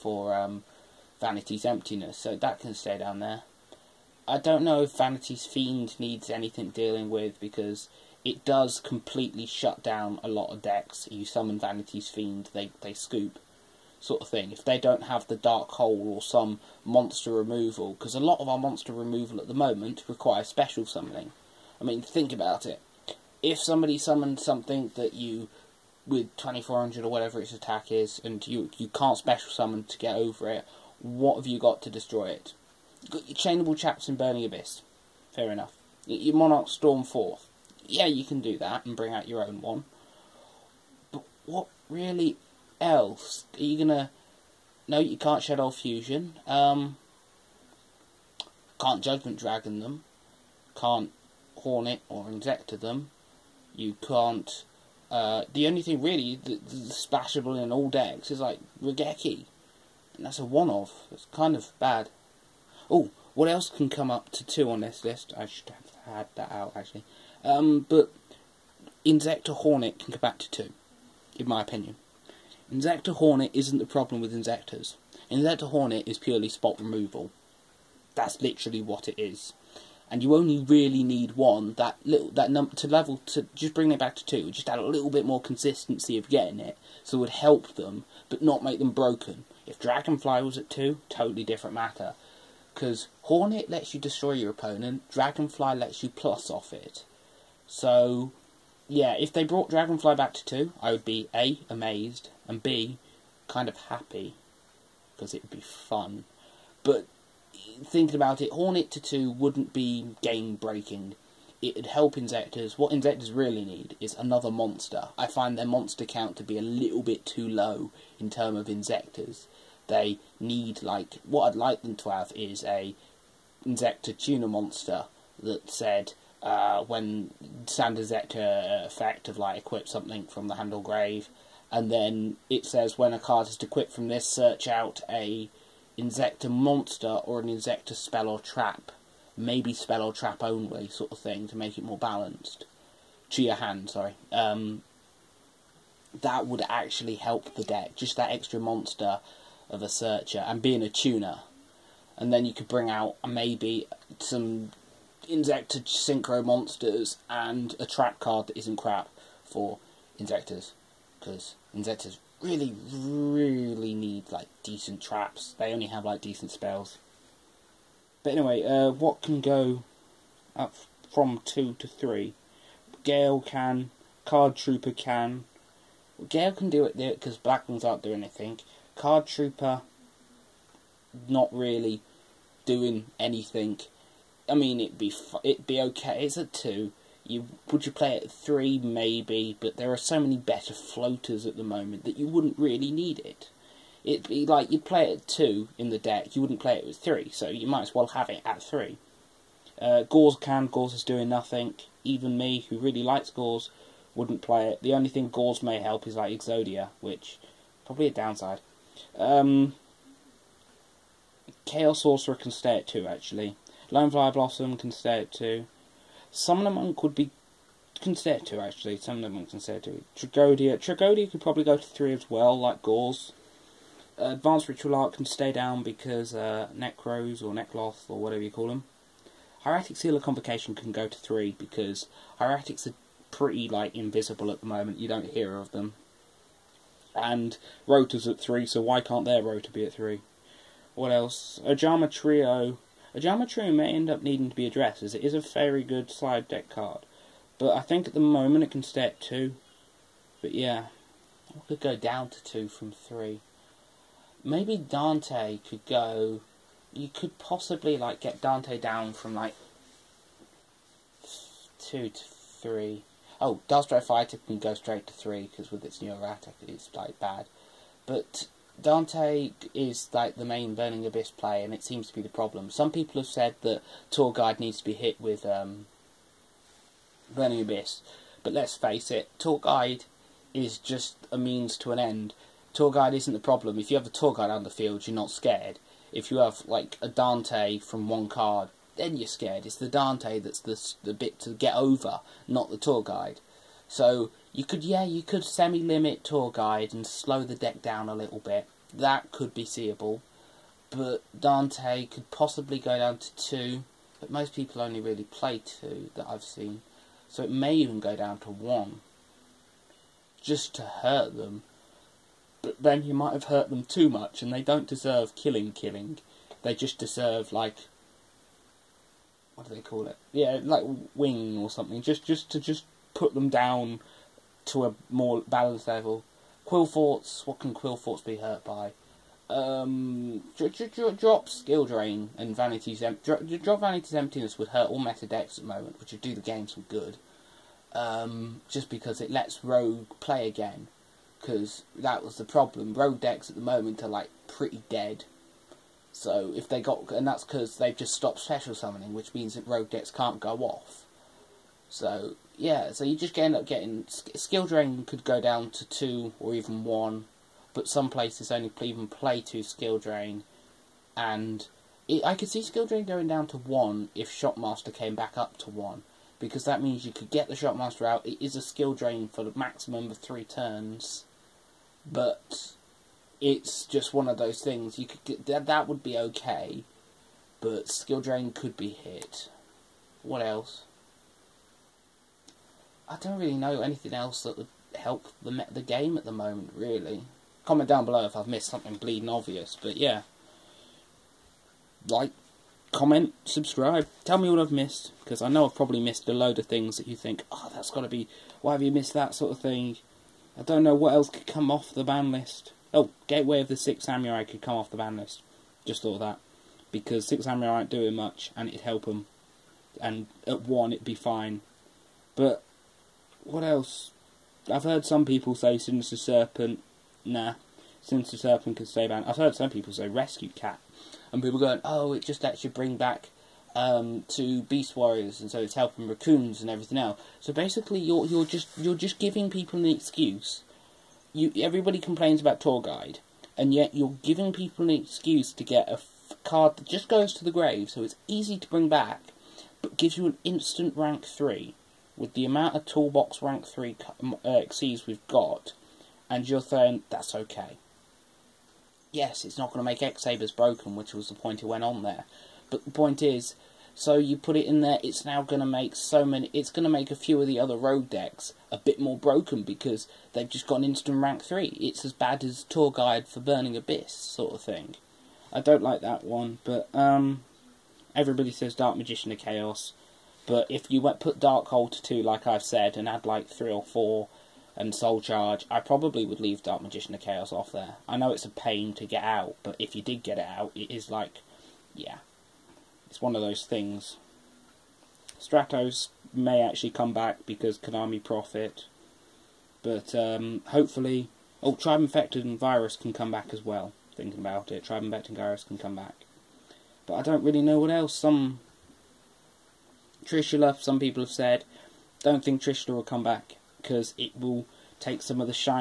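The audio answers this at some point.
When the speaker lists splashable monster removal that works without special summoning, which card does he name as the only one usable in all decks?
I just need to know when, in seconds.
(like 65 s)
58 s.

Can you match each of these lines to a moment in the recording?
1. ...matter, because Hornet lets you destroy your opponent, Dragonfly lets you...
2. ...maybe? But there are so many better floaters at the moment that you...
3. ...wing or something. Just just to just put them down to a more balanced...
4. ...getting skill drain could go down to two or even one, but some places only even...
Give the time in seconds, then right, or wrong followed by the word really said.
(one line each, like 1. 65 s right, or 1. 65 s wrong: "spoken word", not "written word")
1. 91 s right
2. 188 s right
3. 321 s right
4. 353 s right.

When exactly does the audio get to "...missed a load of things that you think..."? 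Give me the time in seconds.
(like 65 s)
395 s.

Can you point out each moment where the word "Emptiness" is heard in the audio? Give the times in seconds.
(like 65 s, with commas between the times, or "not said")
1 s, 334 s.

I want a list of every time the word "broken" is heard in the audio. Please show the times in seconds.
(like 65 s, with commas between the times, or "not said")
88 s, 450 s, 459 s.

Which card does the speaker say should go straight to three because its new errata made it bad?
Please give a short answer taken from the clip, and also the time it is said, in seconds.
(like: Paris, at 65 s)
Dastro Fighter, at 263 s.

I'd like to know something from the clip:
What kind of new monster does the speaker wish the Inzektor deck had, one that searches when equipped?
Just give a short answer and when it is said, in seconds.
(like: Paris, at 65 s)
Tuner monster, at 124 s.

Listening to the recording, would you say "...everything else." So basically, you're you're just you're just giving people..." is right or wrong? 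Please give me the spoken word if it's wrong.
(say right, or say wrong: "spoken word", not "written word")
right.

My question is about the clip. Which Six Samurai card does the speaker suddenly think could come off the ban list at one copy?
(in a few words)
Gateway of the Six Samurai.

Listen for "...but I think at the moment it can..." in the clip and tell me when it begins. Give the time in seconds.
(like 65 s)
247 s.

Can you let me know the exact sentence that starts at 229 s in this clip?
Hieratic Seal of Convocation can go to 3 because Hieratics are pretty like invisible at the moment.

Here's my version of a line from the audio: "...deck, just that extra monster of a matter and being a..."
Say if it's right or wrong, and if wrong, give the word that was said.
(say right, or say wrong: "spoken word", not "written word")
wrong: "searcher", not "matter".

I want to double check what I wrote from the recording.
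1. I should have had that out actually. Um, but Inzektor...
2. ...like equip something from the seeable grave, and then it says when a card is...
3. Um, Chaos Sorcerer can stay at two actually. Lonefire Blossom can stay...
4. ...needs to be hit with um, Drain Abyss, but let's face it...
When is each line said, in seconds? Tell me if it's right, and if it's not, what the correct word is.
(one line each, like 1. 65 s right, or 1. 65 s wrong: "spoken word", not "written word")
1. 65 s right
2. 129 s wrong: "handle", not "seeable"
3. 209 s right
4. 274 s wrong: "Burning", not "Drain".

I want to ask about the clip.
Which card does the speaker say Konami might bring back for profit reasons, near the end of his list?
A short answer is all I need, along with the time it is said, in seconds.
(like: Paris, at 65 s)
Stratos, at 485 s.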